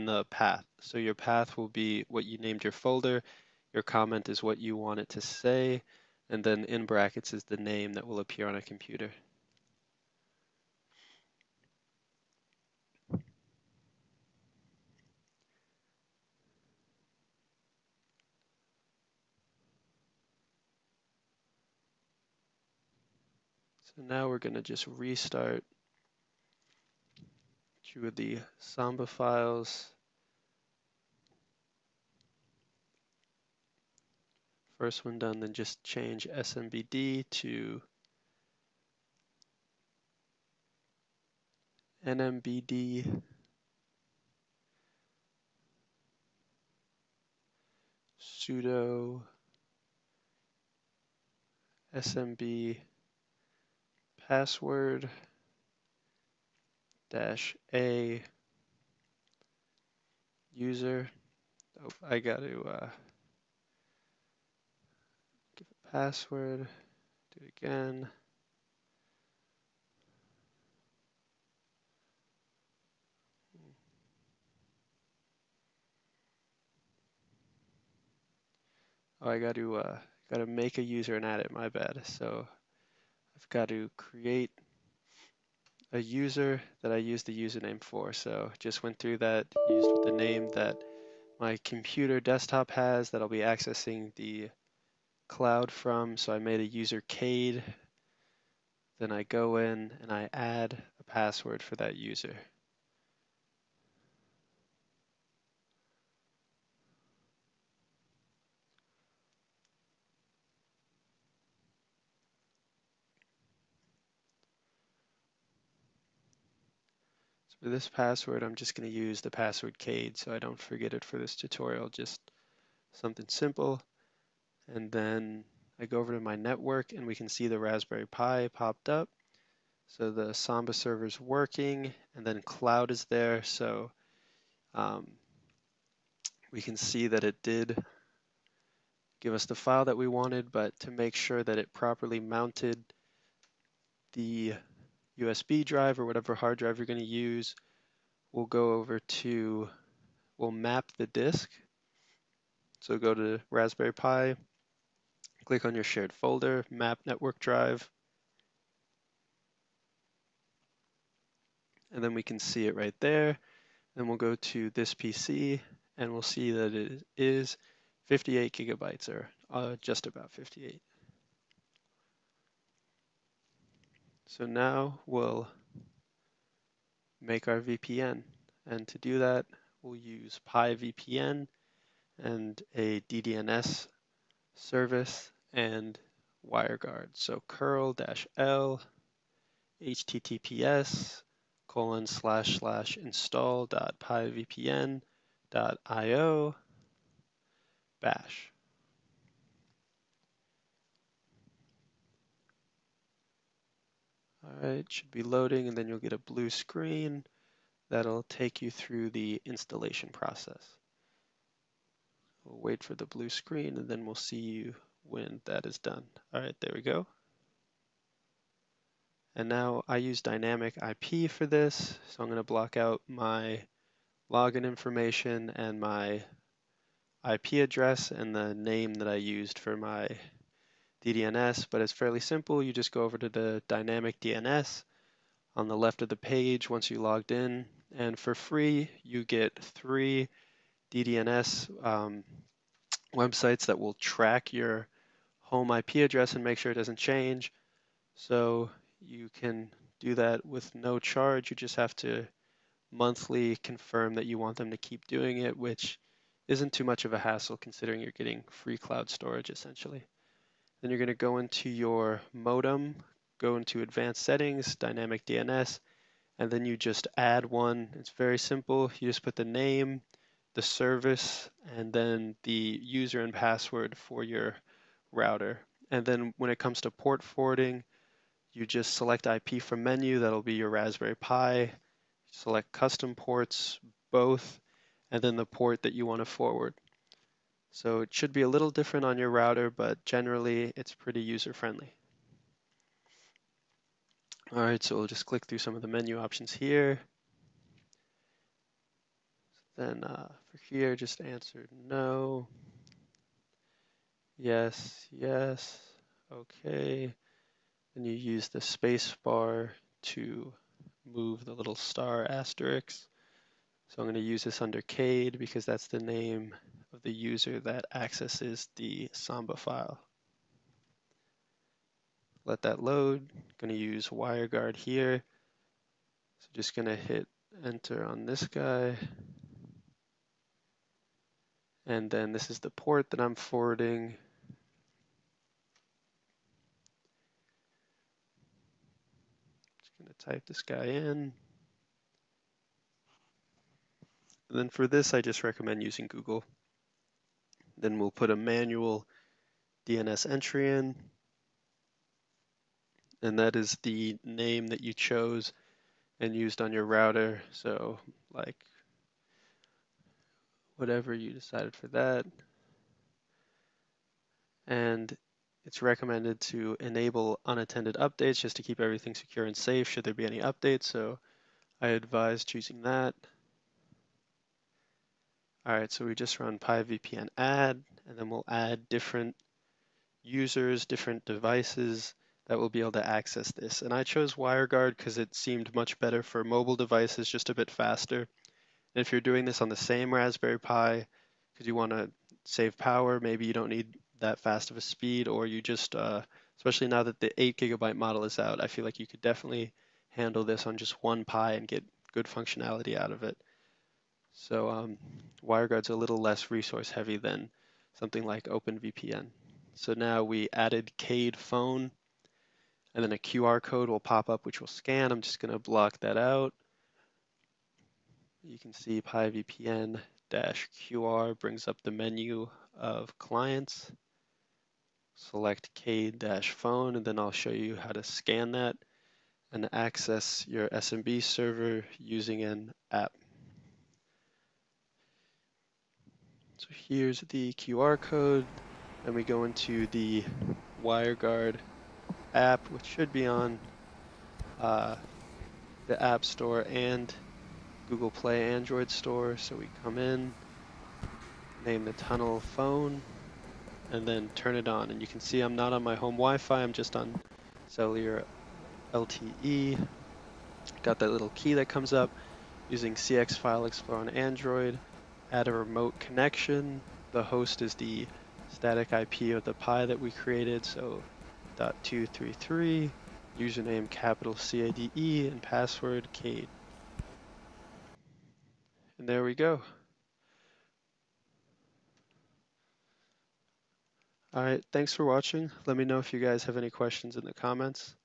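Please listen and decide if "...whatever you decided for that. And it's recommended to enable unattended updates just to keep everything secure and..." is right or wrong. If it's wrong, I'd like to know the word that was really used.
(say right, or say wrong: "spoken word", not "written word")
right.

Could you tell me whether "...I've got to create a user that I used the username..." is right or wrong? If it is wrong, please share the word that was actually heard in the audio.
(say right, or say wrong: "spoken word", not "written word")
right.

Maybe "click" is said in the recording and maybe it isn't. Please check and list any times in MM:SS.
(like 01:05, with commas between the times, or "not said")
02:35, 04:55.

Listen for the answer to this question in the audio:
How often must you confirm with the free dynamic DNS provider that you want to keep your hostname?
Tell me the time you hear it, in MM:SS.
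04:12.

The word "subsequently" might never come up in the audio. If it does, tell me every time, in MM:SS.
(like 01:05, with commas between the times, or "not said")
not said.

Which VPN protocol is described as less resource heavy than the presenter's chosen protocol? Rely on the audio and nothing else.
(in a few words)
OpenVPN.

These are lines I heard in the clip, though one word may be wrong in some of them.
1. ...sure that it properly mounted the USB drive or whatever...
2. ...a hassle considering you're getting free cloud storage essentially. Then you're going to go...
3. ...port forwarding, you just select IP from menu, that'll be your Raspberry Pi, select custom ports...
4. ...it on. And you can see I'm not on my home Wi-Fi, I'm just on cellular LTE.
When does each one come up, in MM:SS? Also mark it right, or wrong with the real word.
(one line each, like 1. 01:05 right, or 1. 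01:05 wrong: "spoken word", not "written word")
1. 02:21 right
2. 04:17 right
3. 04:36 right
4. 07:34 right.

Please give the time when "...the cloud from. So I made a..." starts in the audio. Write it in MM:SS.
01:34.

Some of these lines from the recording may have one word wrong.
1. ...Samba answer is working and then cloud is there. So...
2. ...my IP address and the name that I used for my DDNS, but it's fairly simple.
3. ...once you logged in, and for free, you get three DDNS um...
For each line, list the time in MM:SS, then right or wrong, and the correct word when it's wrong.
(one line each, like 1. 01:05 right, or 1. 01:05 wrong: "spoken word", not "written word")
1. 02:10 wrong: "server", not "answer"
2. 03:45 right
3. 03:56 right.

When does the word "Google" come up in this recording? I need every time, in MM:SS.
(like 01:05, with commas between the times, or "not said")
05:46, 07:27.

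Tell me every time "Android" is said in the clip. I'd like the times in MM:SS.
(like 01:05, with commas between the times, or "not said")
07:28, 07:44.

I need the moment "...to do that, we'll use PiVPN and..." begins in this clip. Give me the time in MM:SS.
02:58.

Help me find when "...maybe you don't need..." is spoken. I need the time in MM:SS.
06:33.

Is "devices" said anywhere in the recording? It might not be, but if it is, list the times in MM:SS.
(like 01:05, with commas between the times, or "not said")
06:21, 06:26.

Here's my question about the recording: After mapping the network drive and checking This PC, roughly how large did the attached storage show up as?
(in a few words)
58 gigabytes.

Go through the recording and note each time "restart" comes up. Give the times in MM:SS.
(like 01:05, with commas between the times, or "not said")
00:24.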